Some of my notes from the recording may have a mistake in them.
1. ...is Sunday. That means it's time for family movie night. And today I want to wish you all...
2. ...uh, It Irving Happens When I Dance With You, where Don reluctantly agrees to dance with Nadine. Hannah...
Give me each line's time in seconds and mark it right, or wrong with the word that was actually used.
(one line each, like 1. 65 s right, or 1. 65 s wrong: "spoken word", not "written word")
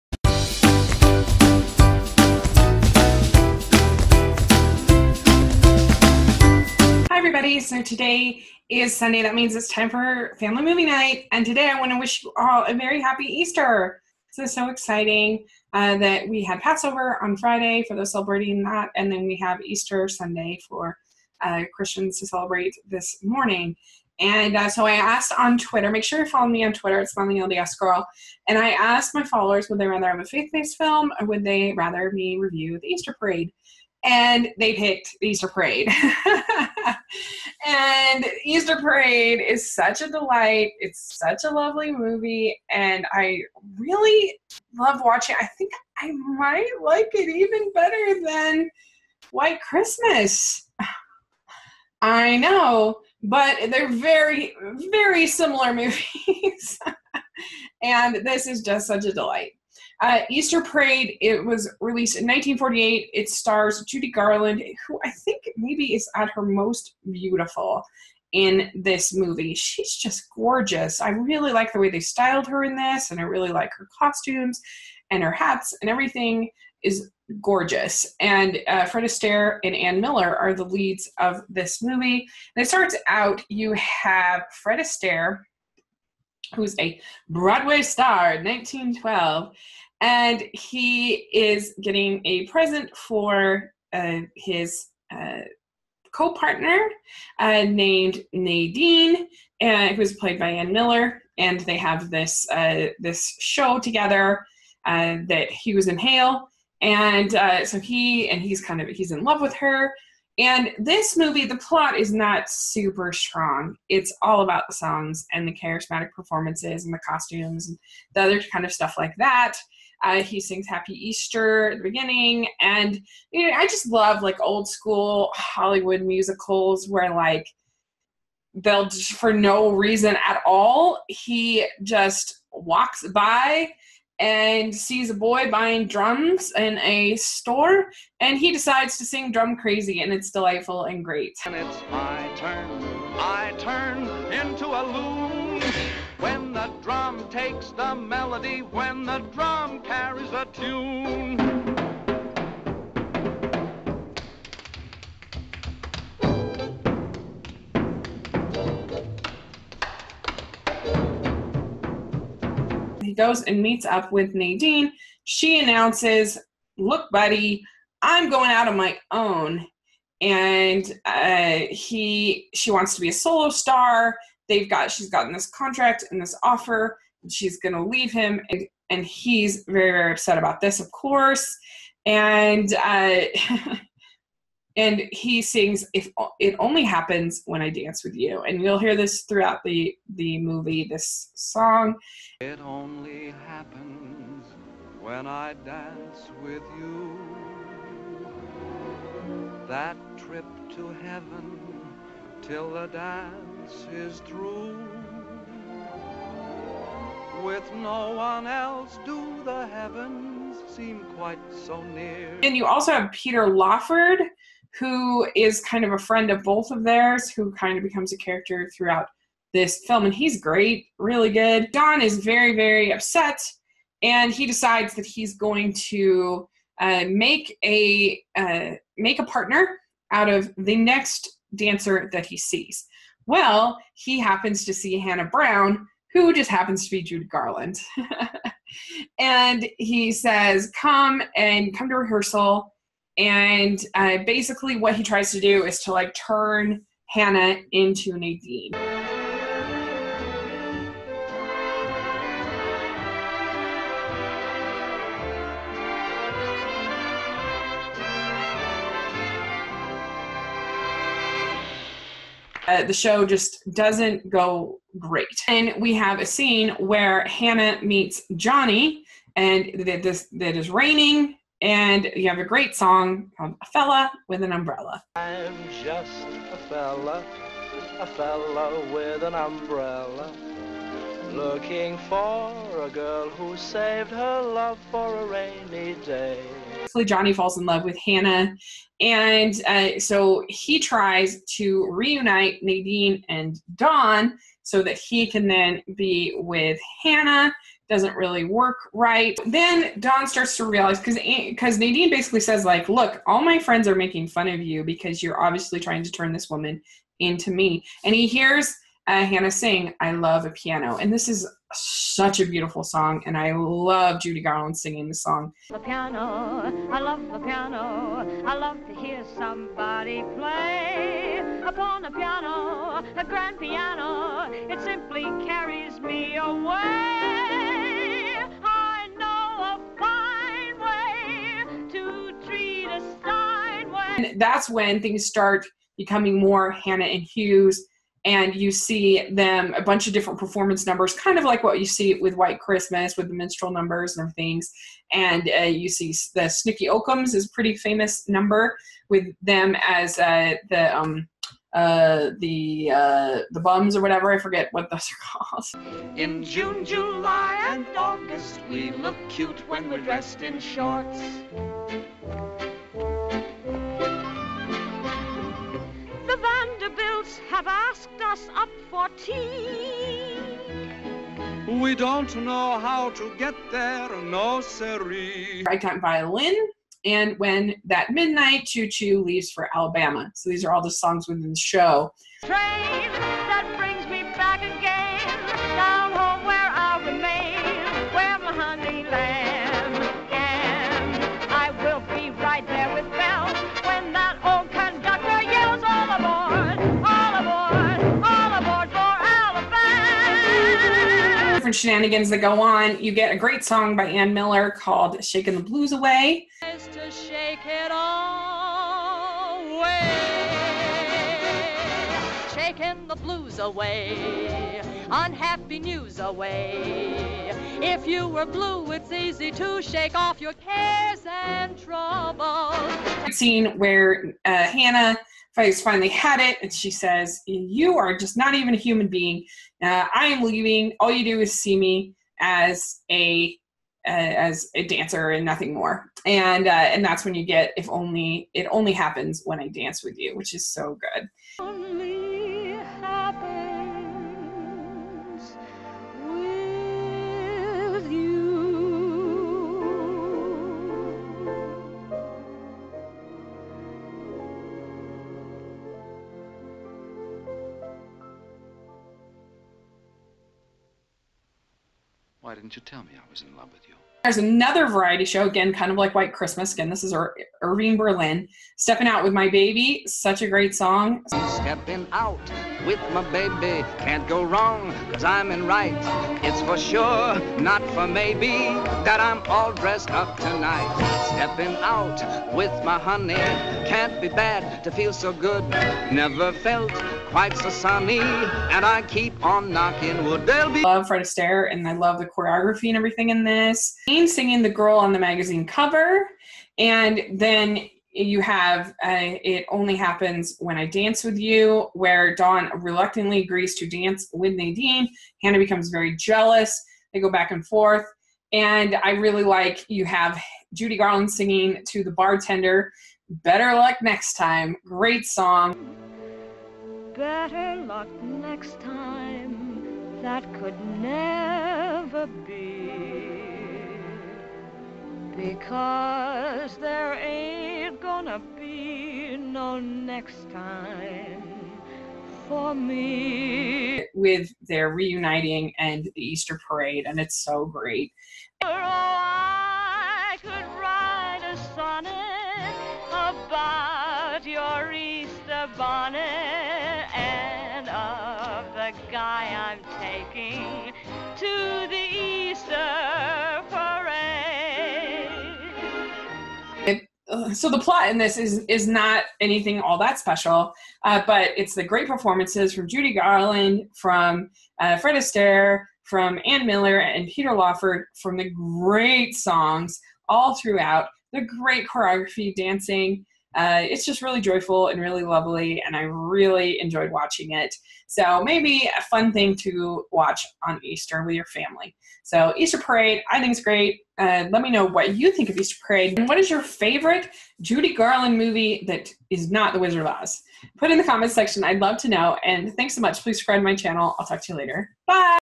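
1. 8 s right
2. 499 s wrong: "Only", not "Irving".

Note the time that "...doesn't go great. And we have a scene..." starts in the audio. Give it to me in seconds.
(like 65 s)
263 s.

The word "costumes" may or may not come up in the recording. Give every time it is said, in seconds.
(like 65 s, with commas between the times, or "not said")
73 s, 117 s.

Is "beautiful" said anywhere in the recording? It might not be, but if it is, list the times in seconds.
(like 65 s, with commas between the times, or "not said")
67 s, 312 s.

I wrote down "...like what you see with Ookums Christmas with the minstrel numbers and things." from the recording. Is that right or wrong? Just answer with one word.
wrong.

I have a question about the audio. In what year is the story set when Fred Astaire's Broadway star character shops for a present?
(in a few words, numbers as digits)
1912.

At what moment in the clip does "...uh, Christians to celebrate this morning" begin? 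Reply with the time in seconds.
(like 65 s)
21 s.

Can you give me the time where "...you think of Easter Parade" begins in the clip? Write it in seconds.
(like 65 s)
585 s.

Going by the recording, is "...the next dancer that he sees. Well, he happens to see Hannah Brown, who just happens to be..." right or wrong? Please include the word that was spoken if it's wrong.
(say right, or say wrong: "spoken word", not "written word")
right.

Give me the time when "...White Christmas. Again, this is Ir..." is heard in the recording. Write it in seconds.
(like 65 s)
466 s.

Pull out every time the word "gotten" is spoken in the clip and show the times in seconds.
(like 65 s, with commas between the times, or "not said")
175 s.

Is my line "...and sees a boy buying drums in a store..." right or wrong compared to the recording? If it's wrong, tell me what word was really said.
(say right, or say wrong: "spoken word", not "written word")
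right.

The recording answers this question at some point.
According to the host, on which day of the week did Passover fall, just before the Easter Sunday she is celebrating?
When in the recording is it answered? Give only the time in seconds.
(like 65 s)
17 s.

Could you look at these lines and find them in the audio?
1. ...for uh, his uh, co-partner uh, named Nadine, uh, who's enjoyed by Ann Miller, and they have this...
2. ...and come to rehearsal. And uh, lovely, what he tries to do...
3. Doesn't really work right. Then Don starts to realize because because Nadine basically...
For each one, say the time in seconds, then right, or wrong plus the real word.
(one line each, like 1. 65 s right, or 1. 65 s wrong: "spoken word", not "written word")
1. 92 s wrong: "played", not "enjoyed"
2. 241 s wrong: "basically", not "lovely"
3. 297 s right.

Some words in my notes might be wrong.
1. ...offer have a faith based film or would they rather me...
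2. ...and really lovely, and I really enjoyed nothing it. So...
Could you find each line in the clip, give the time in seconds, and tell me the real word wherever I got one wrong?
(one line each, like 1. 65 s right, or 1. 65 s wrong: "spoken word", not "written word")
1. 29 s wrong: "rather", not "offer"
2. 574 s wrong: "watching", not "nothing".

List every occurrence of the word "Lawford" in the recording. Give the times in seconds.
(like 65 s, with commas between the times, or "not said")
213 s, 567 s.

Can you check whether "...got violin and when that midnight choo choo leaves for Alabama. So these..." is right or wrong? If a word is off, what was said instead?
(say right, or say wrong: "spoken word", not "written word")
right.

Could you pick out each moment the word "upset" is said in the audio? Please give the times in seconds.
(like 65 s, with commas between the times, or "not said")
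180 s, 222 s.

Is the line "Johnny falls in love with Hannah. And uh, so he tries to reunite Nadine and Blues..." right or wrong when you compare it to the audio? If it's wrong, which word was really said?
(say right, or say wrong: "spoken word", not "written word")
wrong: "Don", not "Blues".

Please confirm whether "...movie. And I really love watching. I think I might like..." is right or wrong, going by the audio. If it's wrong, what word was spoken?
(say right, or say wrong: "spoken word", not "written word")
right.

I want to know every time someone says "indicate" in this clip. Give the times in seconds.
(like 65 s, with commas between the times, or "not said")
not said.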